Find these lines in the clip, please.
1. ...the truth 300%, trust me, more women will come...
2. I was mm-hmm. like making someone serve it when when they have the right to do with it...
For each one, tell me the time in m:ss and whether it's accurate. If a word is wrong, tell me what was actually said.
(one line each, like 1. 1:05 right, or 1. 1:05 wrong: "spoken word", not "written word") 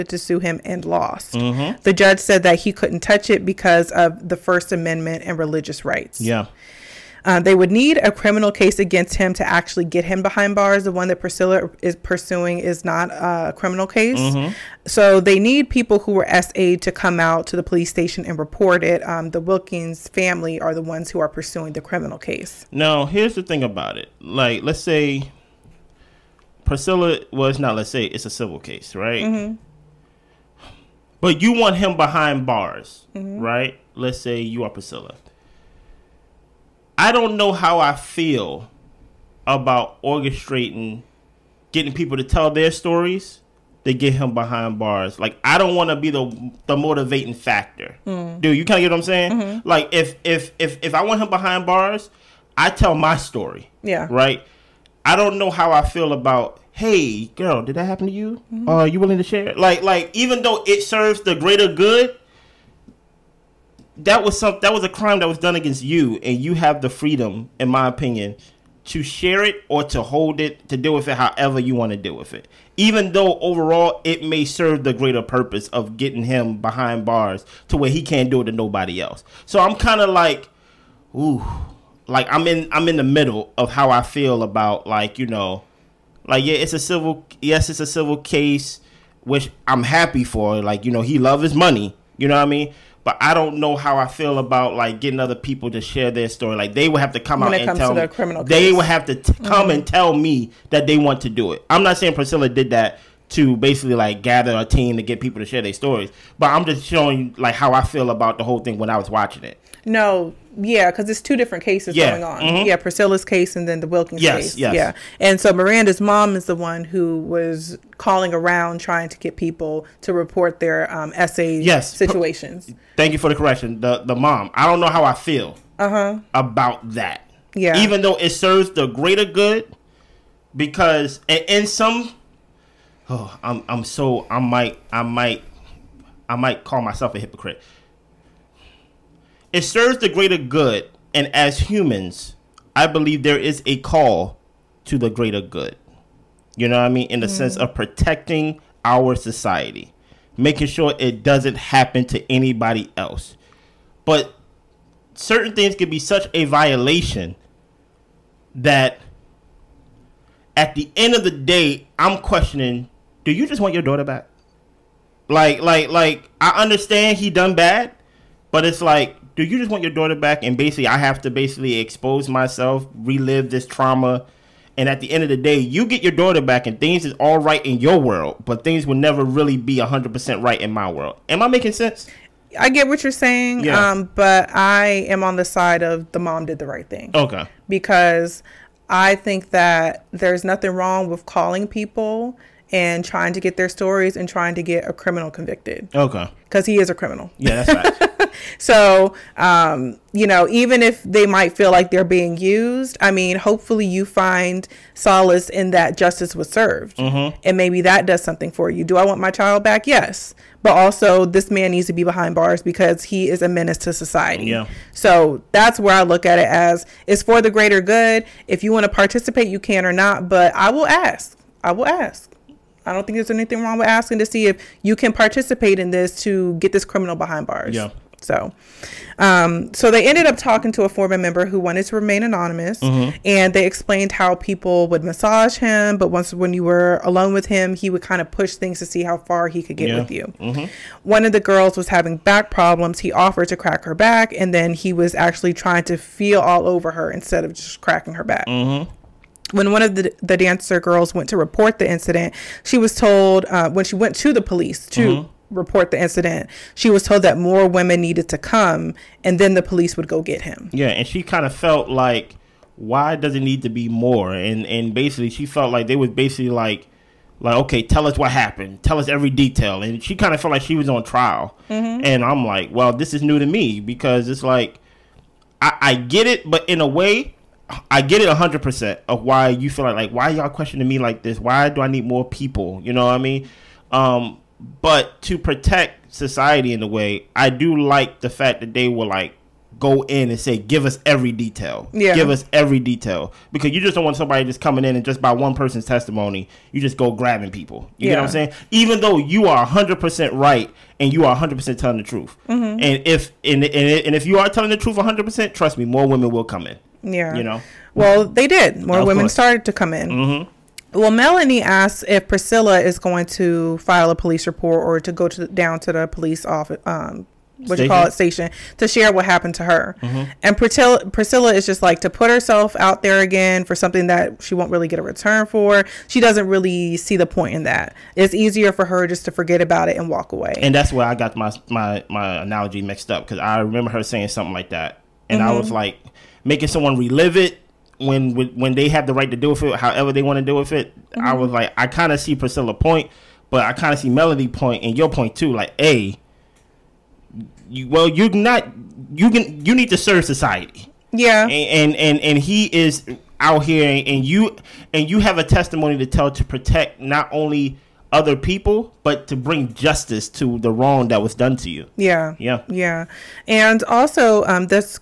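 1. 5:04 wrong: "100", not "300"
2. 5:35 wrong: "relive", not "serve".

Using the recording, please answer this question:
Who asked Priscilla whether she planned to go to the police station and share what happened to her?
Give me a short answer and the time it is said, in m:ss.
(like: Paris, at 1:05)
Melanie, at 5:11.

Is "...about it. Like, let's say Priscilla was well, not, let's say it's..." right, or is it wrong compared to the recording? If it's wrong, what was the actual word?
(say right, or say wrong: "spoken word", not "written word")
right.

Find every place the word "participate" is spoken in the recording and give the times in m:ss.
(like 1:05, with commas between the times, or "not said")
3:38, 3:45.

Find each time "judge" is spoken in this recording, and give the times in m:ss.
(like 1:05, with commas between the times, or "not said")
0:01.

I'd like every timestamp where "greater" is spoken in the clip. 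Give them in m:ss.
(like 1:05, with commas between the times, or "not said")
1:01, 1:14, 2:08, 2:20, 2:25, 3:37.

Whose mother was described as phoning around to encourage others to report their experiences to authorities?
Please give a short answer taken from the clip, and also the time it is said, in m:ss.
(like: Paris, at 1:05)
Miranda, at 1:55.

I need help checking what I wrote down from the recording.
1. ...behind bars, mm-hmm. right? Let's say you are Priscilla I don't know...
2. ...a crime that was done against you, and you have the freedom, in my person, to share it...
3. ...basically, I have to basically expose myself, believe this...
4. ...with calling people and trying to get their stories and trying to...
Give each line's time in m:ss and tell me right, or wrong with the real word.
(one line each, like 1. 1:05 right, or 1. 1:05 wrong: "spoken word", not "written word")
1. 0:31 right
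2. 1:04 wrong: "opinion", not "person"
3. 2:50 wrong: "relive", not "believe"
4. 3:11 right.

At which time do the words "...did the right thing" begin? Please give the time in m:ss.
3:06.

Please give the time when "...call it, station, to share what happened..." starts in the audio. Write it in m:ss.
5:17.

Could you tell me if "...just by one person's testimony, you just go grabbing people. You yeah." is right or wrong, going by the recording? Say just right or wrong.
right.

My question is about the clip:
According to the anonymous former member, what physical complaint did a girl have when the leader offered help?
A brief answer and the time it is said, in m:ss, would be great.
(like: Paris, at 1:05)
Back problems, at 4:02.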